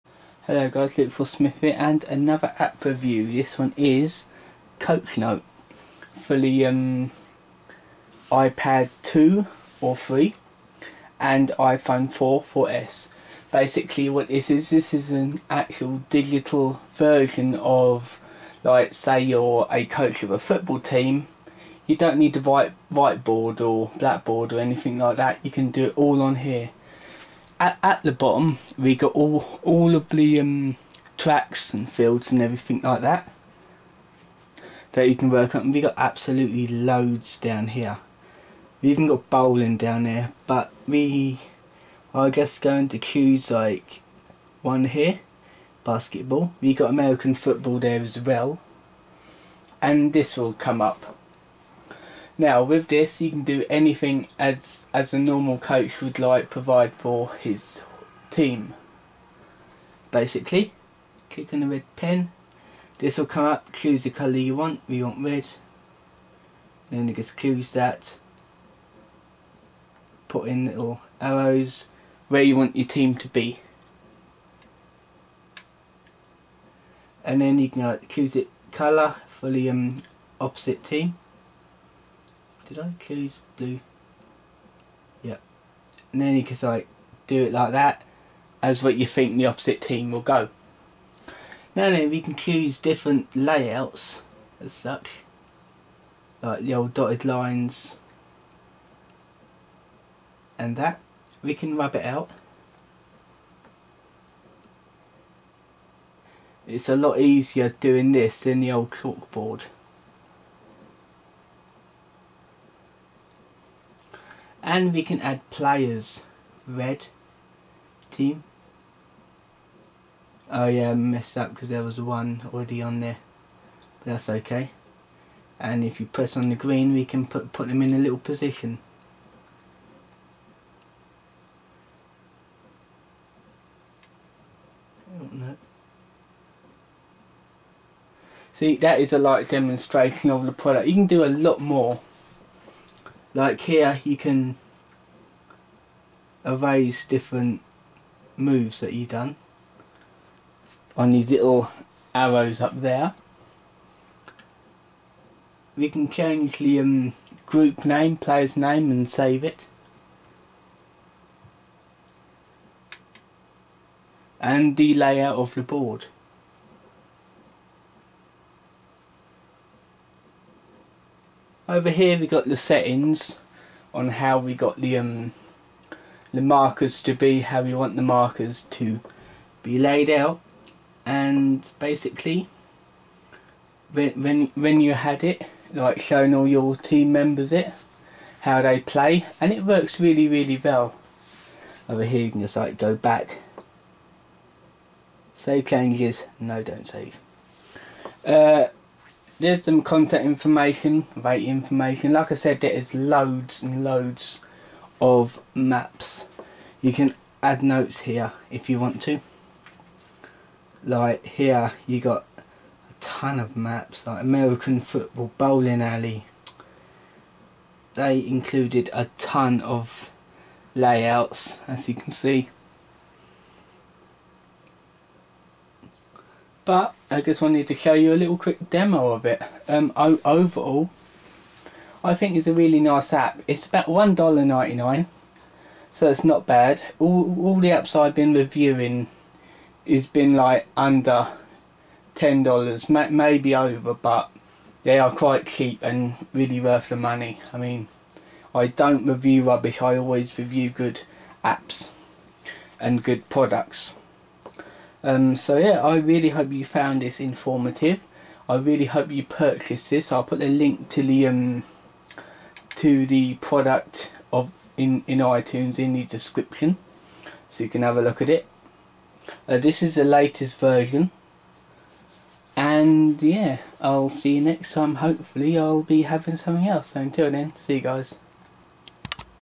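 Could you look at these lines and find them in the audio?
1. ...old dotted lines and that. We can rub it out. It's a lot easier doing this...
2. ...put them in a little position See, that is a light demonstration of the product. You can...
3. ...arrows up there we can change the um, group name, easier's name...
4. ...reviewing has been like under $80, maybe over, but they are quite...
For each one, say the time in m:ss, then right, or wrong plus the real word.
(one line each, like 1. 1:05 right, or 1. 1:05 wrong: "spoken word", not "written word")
1. 1:36 right
2. 2:07 right
3. 2:32 wrong: "player", not "easier"
4. 3:58 wrong: "10", not "80".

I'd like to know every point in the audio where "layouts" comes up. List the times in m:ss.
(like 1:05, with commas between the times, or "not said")
1:33, 2:44, 3:40.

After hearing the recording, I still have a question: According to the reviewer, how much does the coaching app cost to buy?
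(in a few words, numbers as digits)
$1.99.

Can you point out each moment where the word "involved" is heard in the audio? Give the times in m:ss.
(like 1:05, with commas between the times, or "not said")
not said.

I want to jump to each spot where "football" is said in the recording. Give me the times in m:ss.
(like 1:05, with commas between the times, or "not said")
0:20, 0:47, 3:34.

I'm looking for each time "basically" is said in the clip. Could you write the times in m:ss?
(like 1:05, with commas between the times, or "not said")
0:13, 1:00, 3:01.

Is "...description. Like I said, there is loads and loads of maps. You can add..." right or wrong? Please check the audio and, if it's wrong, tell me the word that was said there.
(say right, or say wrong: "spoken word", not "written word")
wrong: "information", not "description".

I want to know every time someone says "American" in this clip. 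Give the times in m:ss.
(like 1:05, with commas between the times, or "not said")
0:46, 3:34.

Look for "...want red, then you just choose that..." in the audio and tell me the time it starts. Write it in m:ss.
1:05.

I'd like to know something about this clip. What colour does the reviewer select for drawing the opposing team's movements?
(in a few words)
Blue.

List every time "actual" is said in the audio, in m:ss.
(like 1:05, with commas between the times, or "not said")
0:15.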